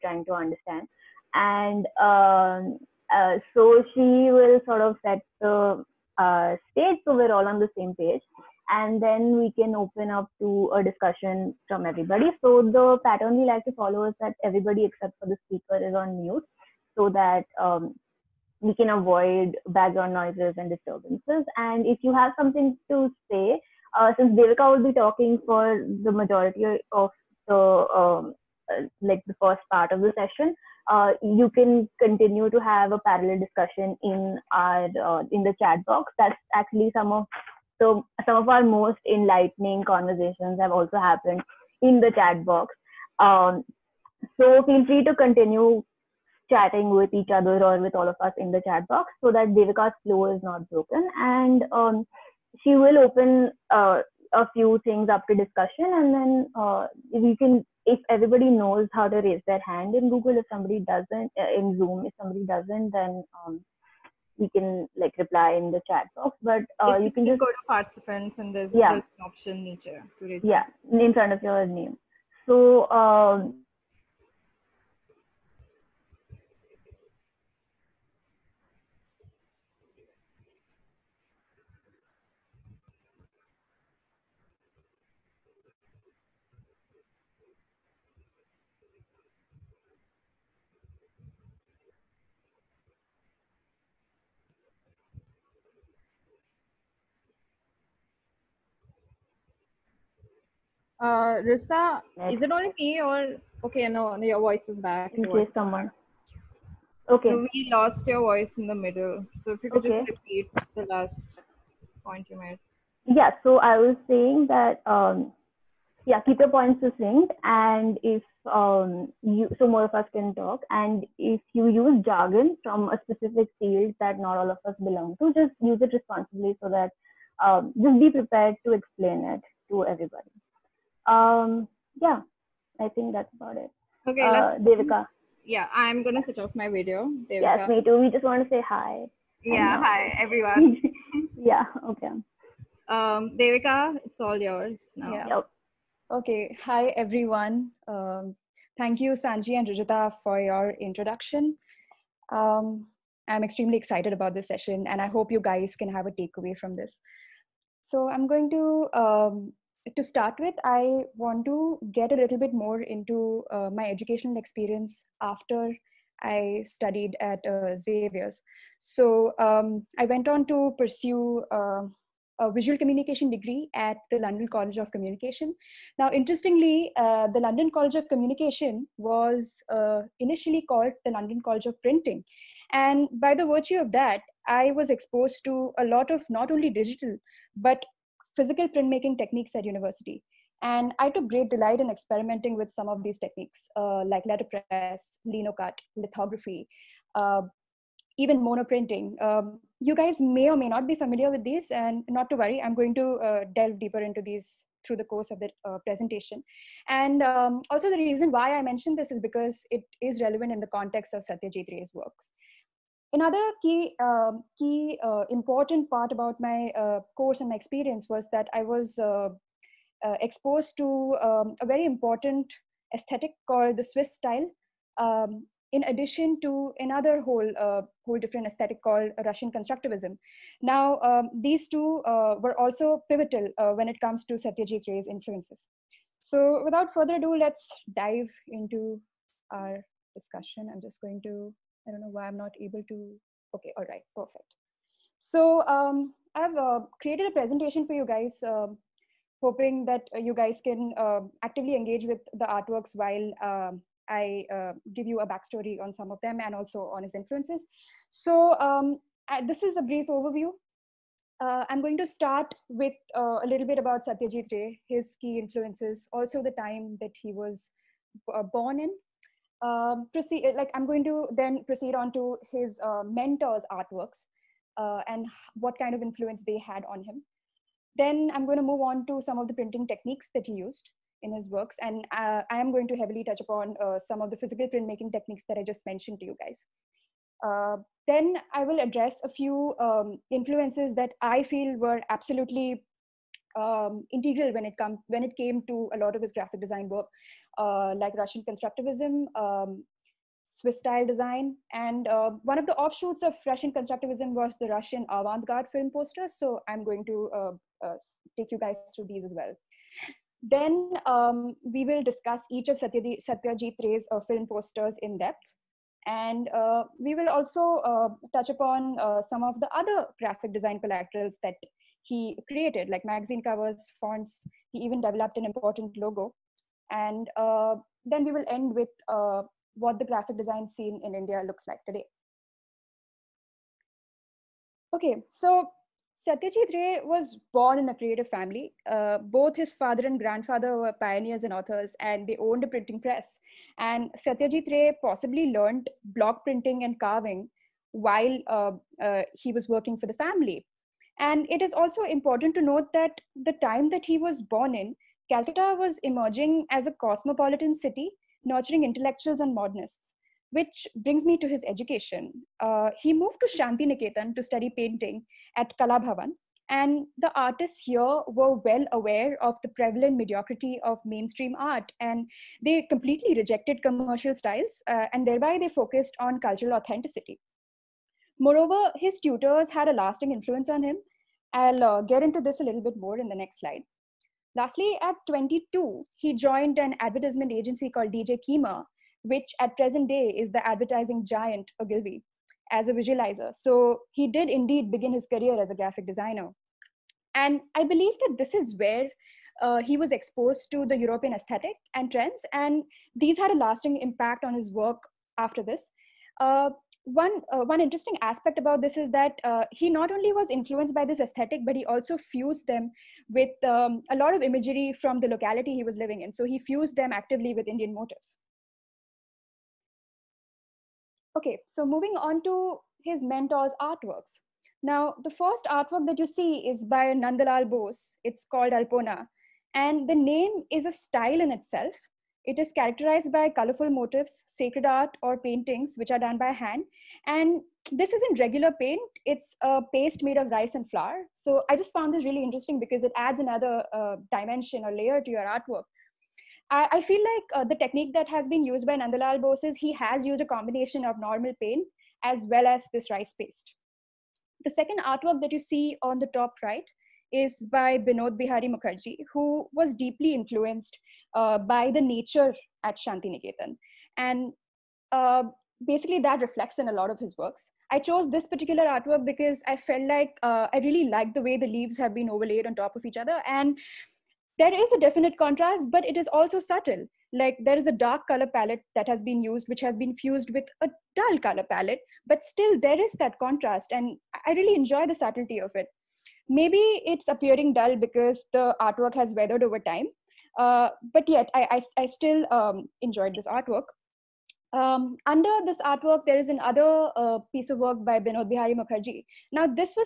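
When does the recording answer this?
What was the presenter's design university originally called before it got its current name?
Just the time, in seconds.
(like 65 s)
181 s.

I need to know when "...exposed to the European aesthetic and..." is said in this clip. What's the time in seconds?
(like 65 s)
400 s.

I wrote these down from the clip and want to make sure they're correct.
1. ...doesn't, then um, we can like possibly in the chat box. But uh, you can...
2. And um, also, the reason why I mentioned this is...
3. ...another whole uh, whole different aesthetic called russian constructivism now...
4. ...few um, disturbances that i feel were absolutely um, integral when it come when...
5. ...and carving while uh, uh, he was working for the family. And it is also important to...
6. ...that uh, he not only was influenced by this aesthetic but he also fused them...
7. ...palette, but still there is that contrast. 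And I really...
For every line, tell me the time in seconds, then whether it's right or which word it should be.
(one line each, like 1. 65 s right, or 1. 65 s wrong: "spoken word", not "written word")
1. 62 s wrong: "reply", not "possibly"
2. 206 s right
3. 226 s right
4. 289 s wrong: "influences", not "disturbances"
5. 346 s right
6. 409 s right
7. 481 s right.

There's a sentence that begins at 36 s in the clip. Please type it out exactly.
That's actually some of so some of our most enlightening conversations have also happened in the chat box.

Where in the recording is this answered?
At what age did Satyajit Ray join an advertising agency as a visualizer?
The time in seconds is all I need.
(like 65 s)
385 s.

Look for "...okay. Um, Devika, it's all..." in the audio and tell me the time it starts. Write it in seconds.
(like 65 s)
141 s.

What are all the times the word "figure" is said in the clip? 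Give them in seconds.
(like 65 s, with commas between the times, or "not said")
not said.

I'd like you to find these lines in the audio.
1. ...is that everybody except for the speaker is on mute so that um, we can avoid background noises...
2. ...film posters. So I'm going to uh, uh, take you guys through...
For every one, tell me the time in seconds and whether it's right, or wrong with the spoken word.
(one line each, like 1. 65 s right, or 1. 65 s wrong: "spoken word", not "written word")
1. 14 s right
2. 305 s right.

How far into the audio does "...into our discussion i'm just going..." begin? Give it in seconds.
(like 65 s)
238 s.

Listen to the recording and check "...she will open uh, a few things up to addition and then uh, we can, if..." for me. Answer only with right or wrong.
wrong.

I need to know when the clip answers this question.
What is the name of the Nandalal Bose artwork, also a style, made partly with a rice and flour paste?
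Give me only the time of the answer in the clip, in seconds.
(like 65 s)
428 s.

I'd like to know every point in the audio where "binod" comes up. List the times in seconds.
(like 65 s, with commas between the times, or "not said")
457 s, 498 s.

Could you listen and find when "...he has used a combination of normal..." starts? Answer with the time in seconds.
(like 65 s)
449 s.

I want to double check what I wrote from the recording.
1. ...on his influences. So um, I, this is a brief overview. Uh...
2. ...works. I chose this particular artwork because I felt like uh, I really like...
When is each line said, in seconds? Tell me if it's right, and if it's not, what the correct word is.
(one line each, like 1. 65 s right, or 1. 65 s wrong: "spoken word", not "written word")
1. 256 s right
2. 467 s right.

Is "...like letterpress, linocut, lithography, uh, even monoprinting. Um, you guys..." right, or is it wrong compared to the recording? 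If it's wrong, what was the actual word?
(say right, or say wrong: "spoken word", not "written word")
right.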